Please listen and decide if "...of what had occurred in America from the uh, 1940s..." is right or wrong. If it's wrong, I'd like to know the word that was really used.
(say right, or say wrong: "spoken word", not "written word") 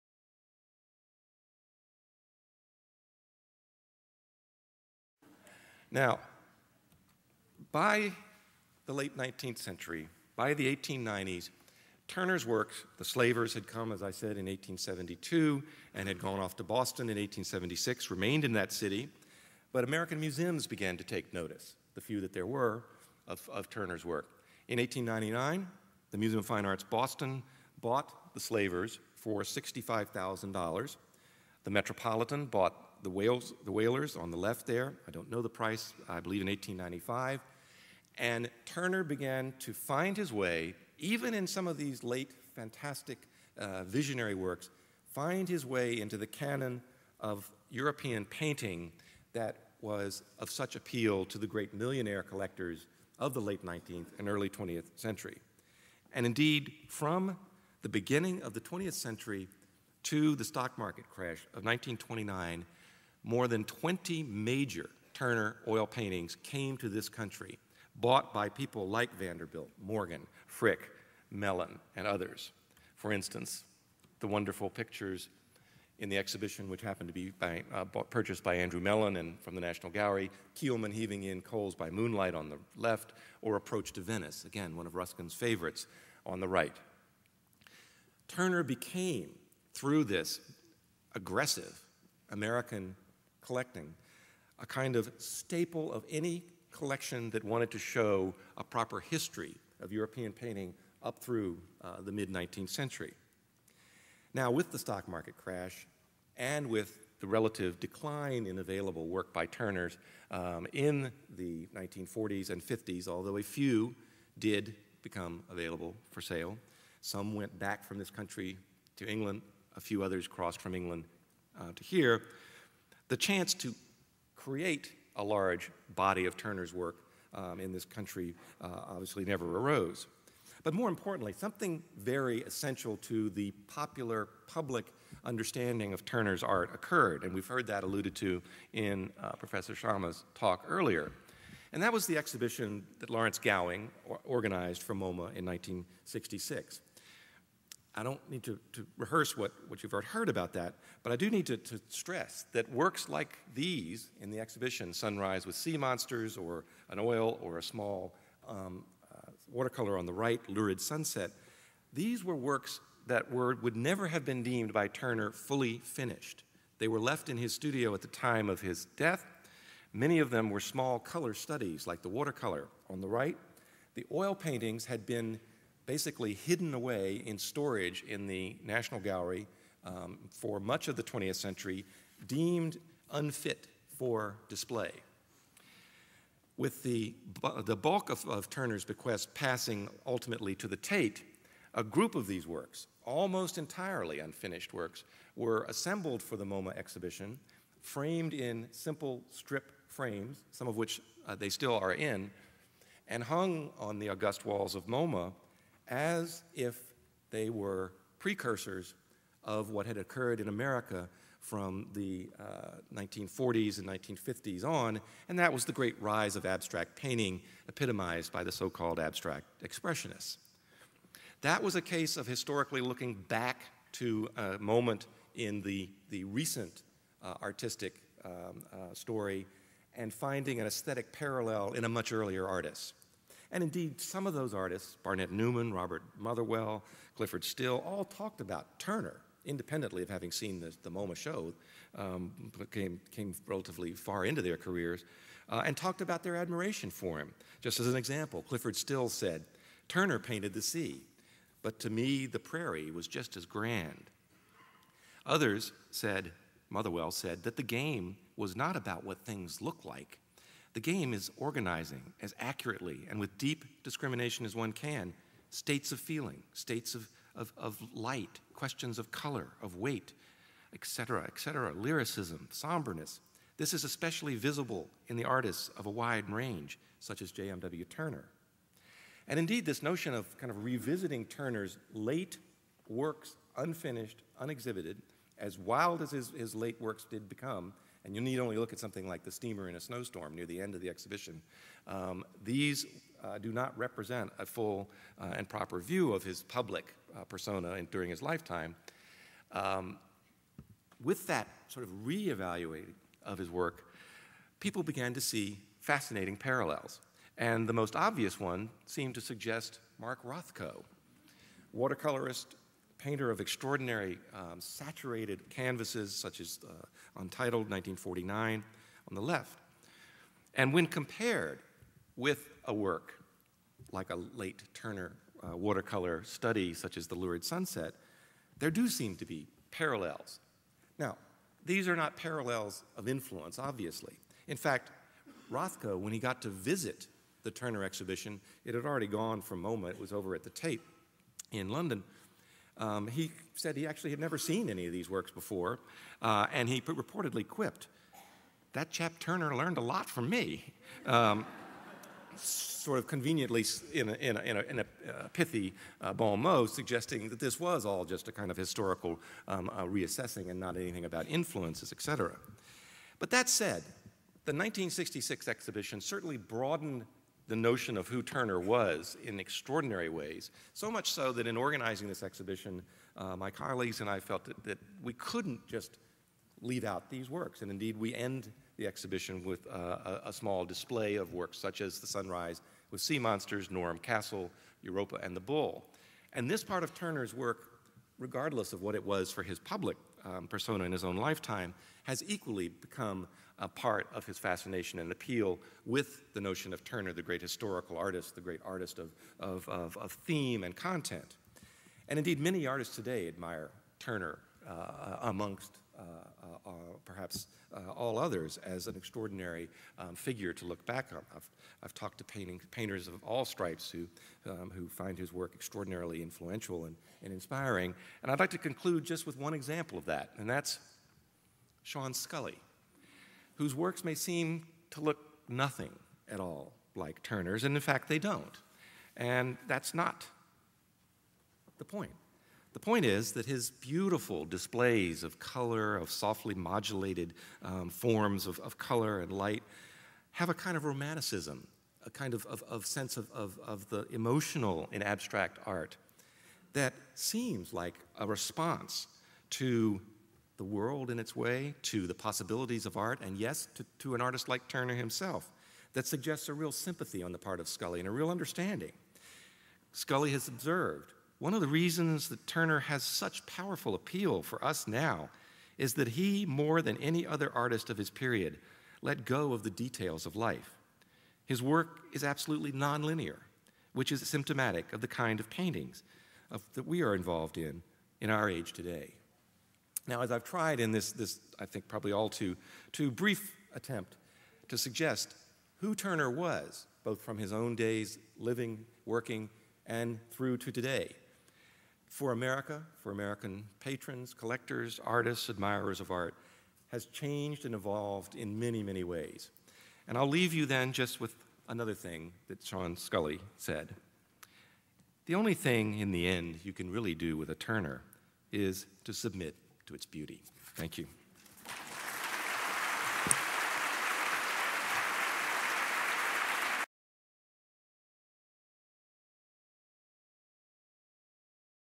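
right.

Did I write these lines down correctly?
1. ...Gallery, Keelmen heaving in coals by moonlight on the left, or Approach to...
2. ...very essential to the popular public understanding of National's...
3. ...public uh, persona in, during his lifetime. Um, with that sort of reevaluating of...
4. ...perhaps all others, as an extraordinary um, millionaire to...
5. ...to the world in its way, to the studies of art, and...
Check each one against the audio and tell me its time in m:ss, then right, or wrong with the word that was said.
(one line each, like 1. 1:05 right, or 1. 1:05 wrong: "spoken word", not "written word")
1. 1:19 right
2. 2:11 wrong: "Turner", not "National"
3. 4:56 right
4. 6:47 wrong: "figure", not "millionaire"
5. 7:29 wrong: "possibilities", not "studies".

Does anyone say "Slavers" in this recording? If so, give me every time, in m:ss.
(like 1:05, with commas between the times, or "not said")
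0:13, 0:28.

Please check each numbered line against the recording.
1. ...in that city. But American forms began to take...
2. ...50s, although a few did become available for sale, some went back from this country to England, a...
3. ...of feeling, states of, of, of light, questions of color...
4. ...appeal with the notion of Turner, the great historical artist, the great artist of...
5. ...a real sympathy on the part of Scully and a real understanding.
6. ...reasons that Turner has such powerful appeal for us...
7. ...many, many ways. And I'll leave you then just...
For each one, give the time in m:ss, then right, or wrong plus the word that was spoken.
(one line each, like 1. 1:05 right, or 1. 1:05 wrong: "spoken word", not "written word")
1. 0:18 wrong: "museums", not "forms"
2. 1:52 right
3. 4:25 right
4. 6:35 right
5. 7:36 right
6. 7:41 right
7. 8:18 right.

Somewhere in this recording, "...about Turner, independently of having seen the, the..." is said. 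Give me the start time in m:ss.
3:58.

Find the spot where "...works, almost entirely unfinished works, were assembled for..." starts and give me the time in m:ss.
3:12.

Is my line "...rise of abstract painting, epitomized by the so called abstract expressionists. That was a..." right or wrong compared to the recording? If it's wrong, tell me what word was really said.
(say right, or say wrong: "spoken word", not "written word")
right.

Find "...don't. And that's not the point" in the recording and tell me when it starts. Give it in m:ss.
7:08.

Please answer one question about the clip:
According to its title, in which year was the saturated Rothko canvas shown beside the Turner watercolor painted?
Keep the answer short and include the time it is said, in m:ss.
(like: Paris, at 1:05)
1949, at 5:17.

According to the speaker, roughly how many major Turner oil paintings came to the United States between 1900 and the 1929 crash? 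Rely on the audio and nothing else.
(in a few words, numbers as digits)
More than 20.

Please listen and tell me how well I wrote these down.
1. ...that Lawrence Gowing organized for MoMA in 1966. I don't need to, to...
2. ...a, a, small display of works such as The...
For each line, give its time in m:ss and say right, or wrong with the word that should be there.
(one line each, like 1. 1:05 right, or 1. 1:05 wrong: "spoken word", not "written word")
1. 2:22 right
2. 6:20 right.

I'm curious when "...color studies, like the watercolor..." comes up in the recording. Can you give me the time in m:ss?
2:50.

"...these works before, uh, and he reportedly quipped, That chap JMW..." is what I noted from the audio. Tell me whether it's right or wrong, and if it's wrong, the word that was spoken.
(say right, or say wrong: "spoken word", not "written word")
wrong: "Turner", not "JMW".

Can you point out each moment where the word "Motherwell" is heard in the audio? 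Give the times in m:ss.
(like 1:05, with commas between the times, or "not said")
3:56, 4:16.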